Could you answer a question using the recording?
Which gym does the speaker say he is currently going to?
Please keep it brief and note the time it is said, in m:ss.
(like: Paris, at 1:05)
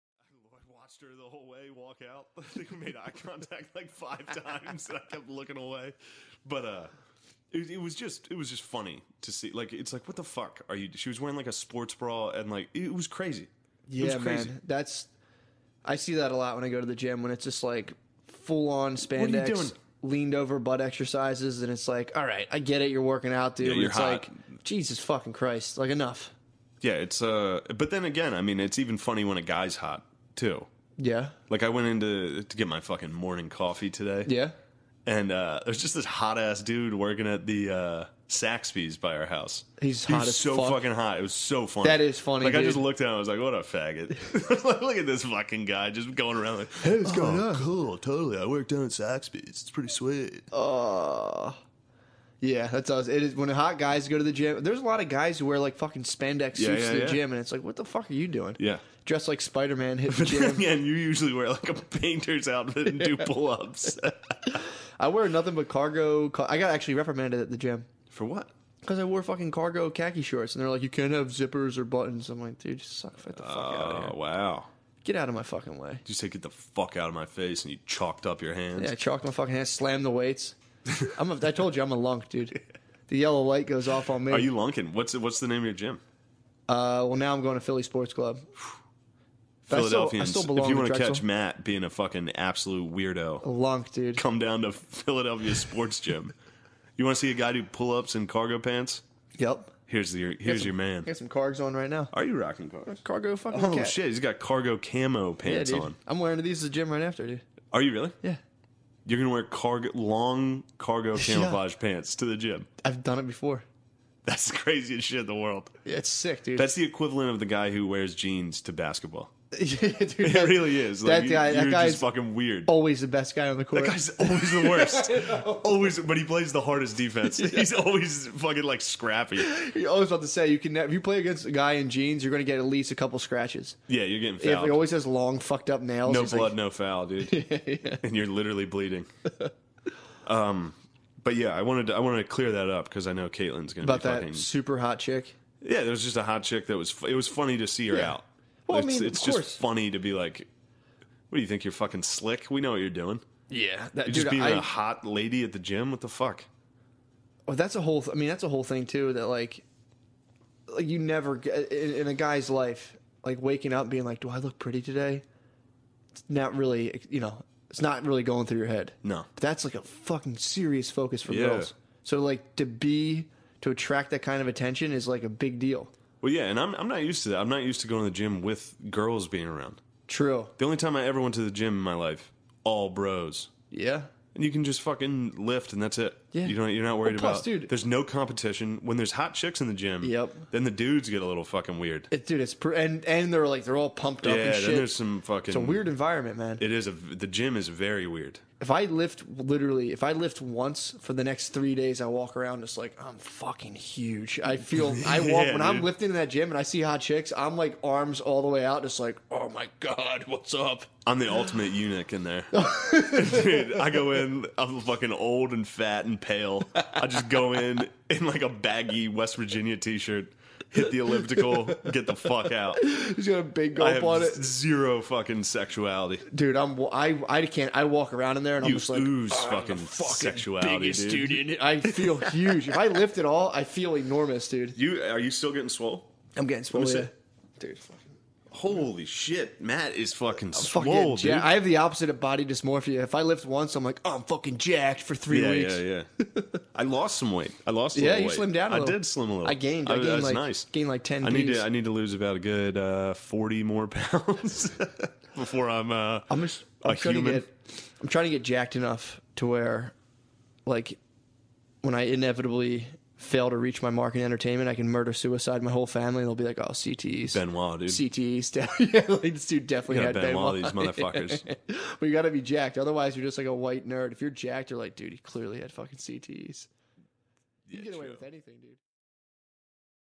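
Philly Sports Club, at 1:27.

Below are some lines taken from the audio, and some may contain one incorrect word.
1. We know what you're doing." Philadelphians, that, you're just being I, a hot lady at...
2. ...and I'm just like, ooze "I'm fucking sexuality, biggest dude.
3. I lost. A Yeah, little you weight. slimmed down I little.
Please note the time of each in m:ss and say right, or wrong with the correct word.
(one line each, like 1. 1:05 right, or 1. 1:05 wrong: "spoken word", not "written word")
1. 2:32 wrong: "Yeah", not "Philadelphians"
2. 3:48 right
3. 4:07 right.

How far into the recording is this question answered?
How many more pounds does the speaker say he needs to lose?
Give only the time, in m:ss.
4:13.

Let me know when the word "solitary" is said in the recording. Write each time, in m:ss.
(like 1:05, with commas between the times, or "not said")
not said.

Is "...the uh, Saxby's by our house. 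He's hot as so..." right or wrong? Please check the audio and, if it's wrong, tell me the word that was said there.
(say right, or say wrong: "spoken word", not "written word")
right.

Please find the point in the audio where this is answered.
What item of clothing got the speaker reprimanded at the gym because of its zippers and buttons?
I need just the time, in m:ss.
1:09.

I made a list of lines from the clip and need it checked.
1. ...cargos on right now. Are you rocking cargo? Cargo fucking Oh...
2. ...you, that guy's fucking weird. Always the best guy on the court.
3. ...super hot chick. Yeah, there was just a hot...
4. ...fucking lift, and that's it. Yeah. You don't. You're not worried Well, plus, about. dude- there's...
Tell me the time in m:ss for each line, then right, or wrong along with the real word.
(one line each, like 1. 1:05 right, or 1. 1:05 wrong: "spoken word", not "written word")
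1. 1:41 right
2. 2:01 right
3. 2:24 right
4. 3:04 right.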